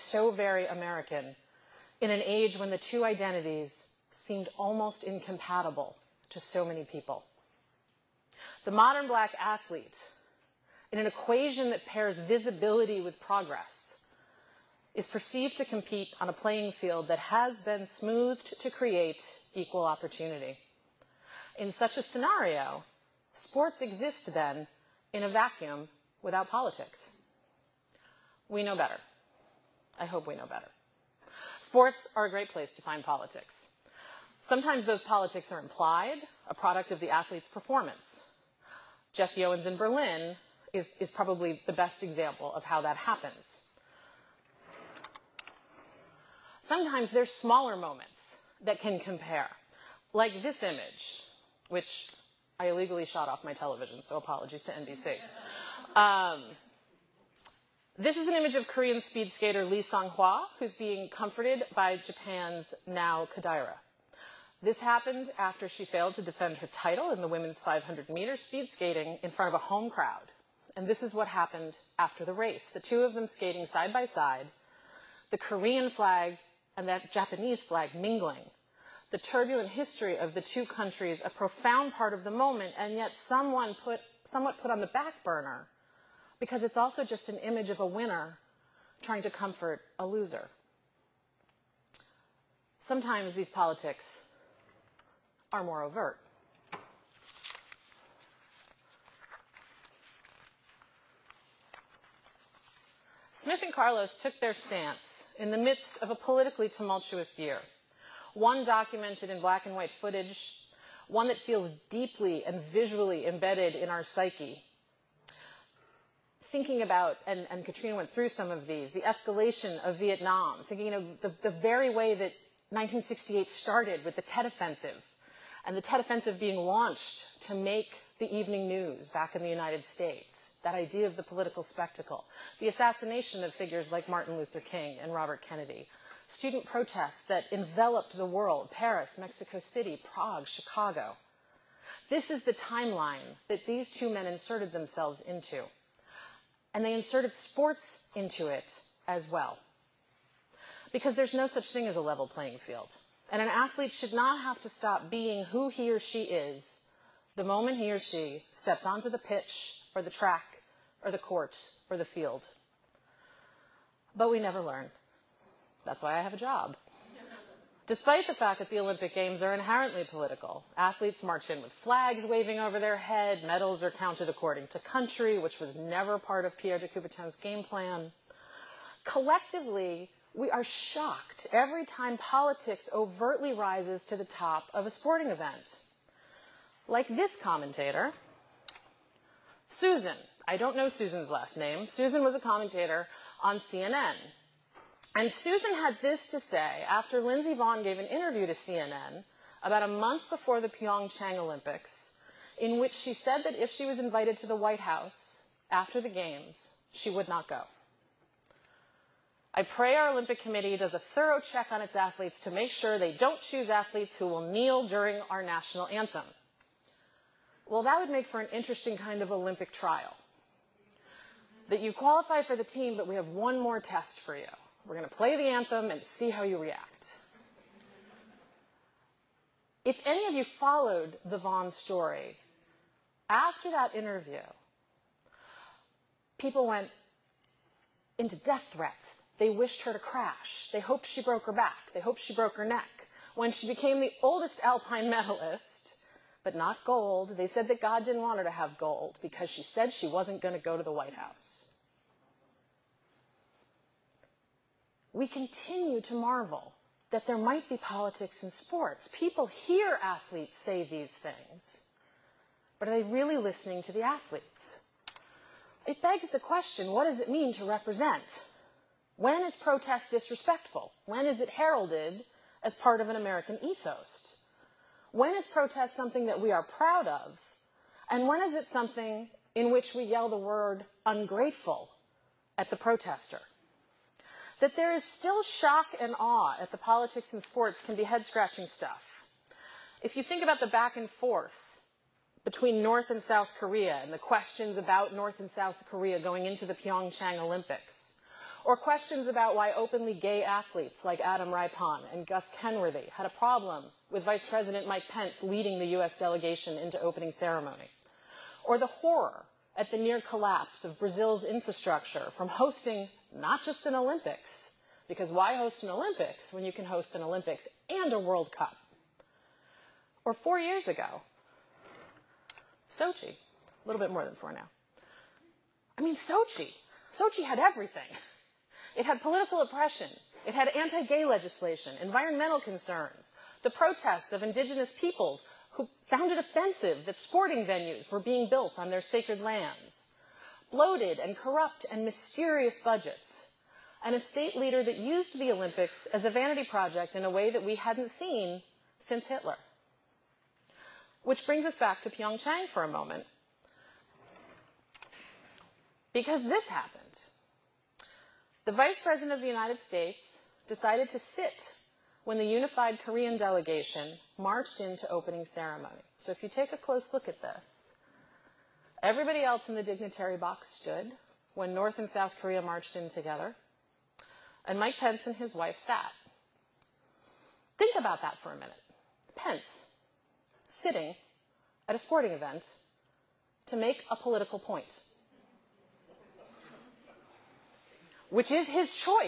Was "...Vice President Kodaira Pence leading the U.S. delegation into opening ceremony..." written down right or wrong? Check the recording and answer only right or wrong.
wrong.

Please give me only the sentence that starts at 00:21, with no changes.
In such a scenario, sports exist then in a vacuum without politics.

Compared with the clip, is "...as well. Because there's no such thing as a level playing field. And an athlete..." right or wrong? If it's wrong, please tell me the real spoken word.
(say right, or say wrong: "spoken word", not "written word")
right.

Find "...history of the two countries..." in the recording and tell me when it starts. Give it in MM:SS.
01:19.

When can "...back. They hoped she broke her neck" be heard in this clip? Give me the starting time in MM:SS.
04:01.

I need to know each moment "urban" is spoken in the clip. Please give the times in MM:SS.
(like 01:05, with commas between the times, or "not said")
not said.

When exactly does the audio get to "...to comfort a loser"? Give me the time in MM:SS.
01:29.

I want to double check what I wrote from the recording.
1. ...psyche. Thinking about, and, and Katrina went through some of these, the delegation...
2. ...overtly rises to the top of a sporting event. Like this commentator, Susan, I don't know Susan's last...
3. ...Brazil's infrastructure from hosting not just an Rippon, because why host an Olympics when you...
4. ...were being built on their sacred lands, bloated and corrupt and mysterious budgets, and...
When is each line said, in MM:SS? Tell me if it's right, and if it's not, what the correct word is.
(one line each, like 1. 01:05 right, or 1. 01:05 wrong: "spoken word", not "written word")
1. 01:54 wrong: "escalation", not "delegation"
2. 03:02 right
3. 05:10 wrong: "Olympics", not "Rippon"
4. 05:38 right.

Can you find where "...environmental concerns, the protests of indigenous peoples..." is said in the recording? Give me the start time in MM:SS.
05:32.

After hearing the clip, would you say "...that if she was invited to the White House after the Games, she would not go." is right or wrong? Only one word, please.
right.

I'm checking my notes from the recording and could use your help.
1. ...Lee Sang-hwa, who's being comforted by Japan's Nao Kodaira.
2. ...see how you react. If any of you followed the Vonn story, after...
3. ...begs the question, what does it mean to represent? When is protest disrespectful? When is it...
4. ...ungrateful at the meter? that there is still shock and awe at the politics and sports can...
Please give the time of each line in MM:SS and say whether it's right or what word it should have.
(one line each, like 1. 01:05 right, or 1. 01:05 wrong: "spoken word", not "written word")
1. 00:59 right
2. 03:46 right
3. 04:26 right
4. 04:41 wrong: "protester", not "meter".